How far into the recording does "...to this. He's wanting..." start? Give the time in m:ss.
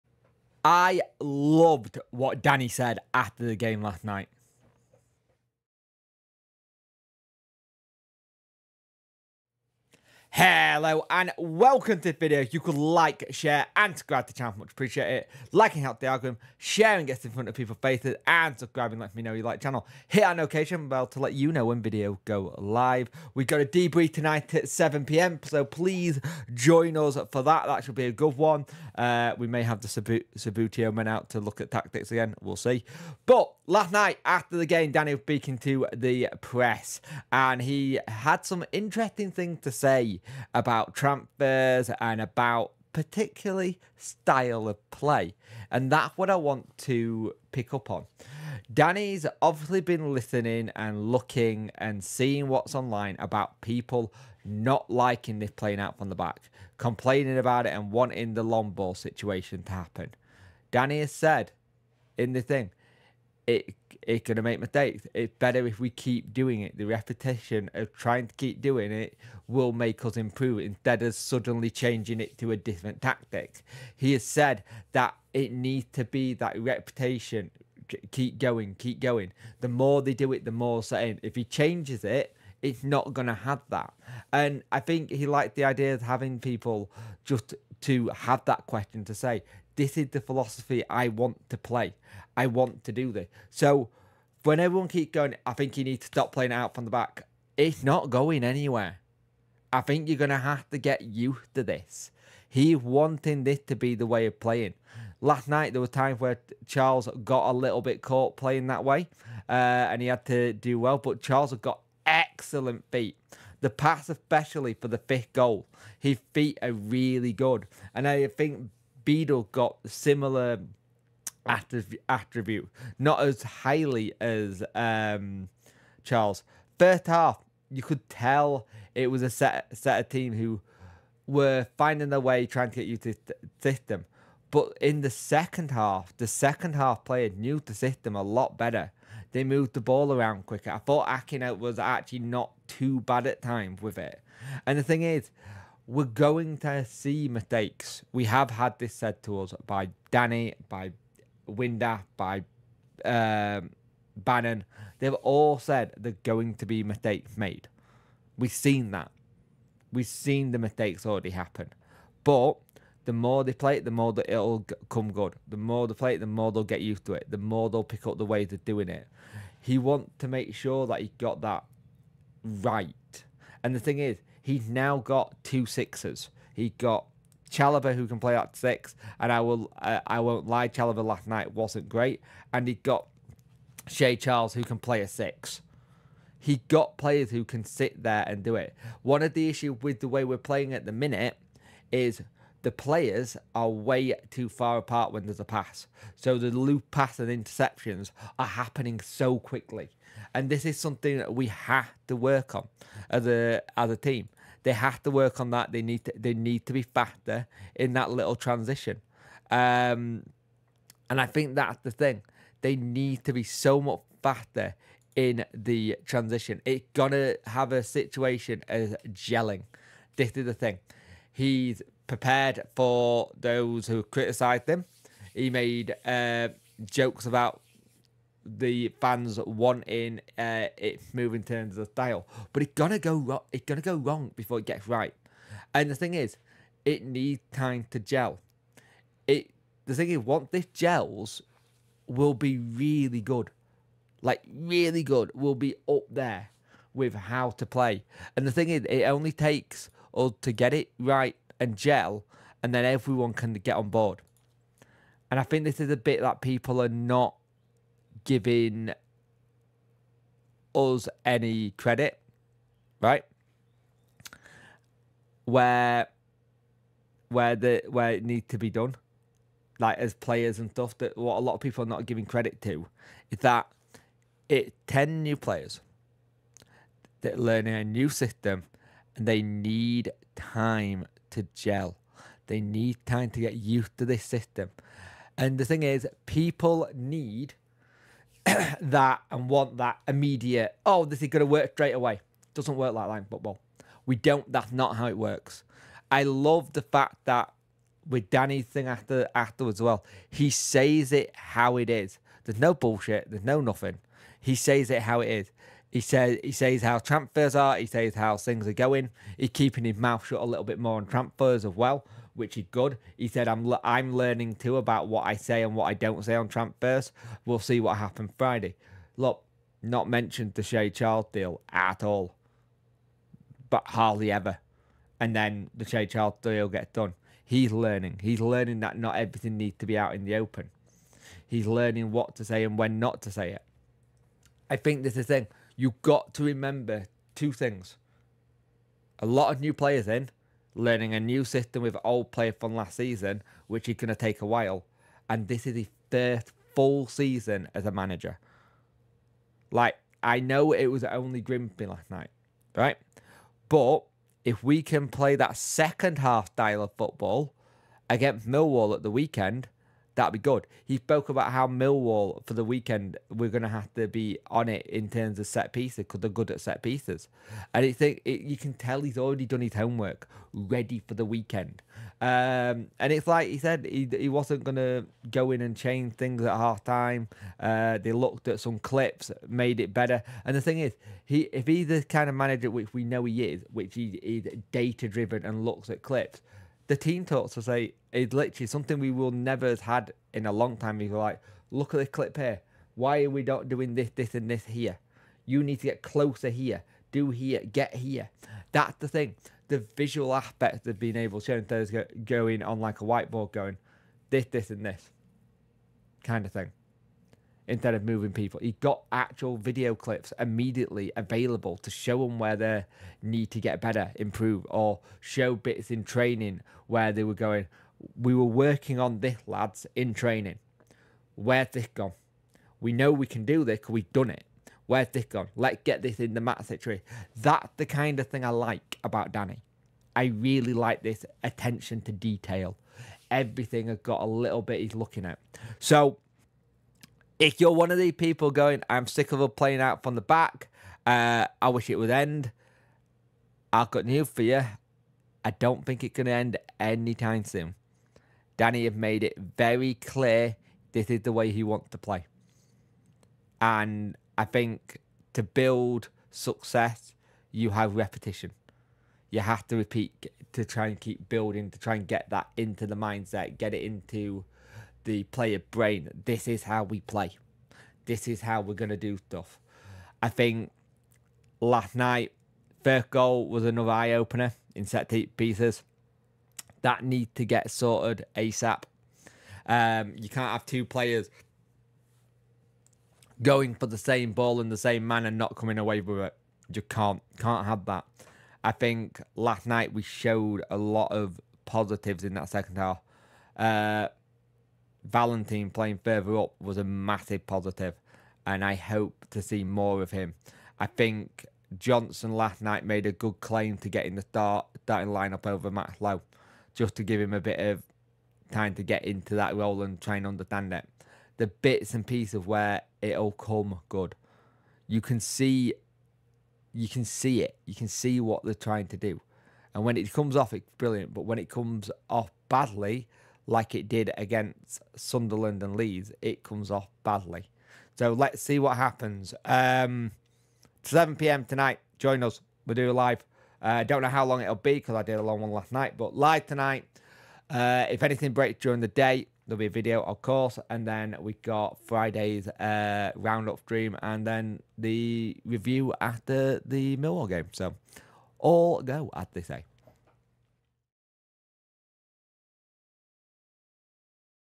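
1:41.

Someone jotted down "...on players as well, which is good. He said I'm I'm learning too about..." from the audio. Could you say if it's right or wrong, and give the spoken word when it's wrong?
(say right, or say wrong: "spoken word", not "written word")
wrong: "transfers", not "players".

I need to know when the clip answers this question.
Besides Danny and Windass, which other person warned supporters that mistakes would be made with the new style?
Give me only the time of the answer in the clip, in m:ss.
2:34.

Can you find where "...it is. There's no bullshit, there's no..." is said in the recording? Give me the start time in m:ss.
5:01.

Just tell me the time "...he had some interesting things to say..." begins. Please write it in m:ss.
0:37.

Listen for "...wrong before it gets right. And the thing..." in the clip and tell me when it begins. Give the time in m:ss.
3:53.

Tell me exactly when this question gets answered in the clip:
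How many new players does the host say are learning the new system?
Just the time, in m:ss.
4:34.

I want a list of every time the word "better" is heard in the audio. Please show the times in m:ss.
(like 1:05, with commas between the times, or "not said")
1:05, 2:18, 6:19, 6:53.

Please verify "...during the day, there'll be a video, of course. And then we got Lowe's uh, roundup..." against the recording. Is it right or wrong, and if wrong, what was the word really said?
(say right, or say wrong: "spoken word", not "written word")
wrong: "Friday", not "Lowe".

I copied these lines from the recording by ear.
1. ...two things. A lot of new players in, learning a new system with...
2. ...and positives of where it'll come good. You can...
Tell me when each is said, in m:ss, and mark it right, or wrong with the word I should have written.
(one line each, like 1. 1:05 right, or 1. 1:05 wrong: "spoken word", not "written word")
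1. 5:37 right
2. 8:31 wrong: "pieces", not "positives".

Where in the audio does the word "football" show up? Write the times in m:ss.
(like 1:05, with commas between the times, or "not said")
4:53, 5:56.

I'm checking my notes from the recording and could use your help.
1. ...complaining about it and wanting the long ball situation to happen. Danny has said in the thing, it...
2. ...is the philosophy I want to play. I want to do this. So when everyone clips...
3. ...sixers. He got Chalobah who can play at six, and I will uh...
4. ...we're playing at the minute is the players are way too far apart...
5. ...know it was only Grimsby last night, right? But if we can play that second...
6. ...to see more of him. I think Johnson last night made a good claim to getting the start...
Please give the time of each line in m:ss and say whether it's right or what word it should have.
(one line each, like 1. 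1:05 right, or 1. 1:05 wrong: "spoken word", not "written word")
1. 0:56 right
2. 1:29 wrong: "keeps", not "clips"
3. 2:55 right
4. 3:10 right
5. 5:50 right
6. 8:19 right.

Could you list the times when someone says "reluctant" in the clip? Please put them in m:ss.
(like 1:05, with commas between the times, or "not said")
not said.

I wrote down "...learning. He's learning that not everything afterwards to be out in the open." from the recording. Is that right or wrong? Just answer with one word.
wrong.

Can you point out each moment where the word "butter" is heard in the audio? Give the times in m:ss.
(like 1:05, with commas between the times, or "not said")
not said.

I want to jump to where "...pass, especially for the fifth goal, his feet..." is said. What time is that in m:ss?
1:53.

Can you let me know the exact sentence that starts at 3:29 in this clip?
Um, and I think that's the thing.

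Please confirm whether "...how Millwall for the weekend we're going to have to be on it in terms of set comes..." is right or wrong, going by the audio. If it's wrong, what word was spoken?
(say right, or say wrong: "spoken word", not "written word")
wrong: "pieces", not "comes".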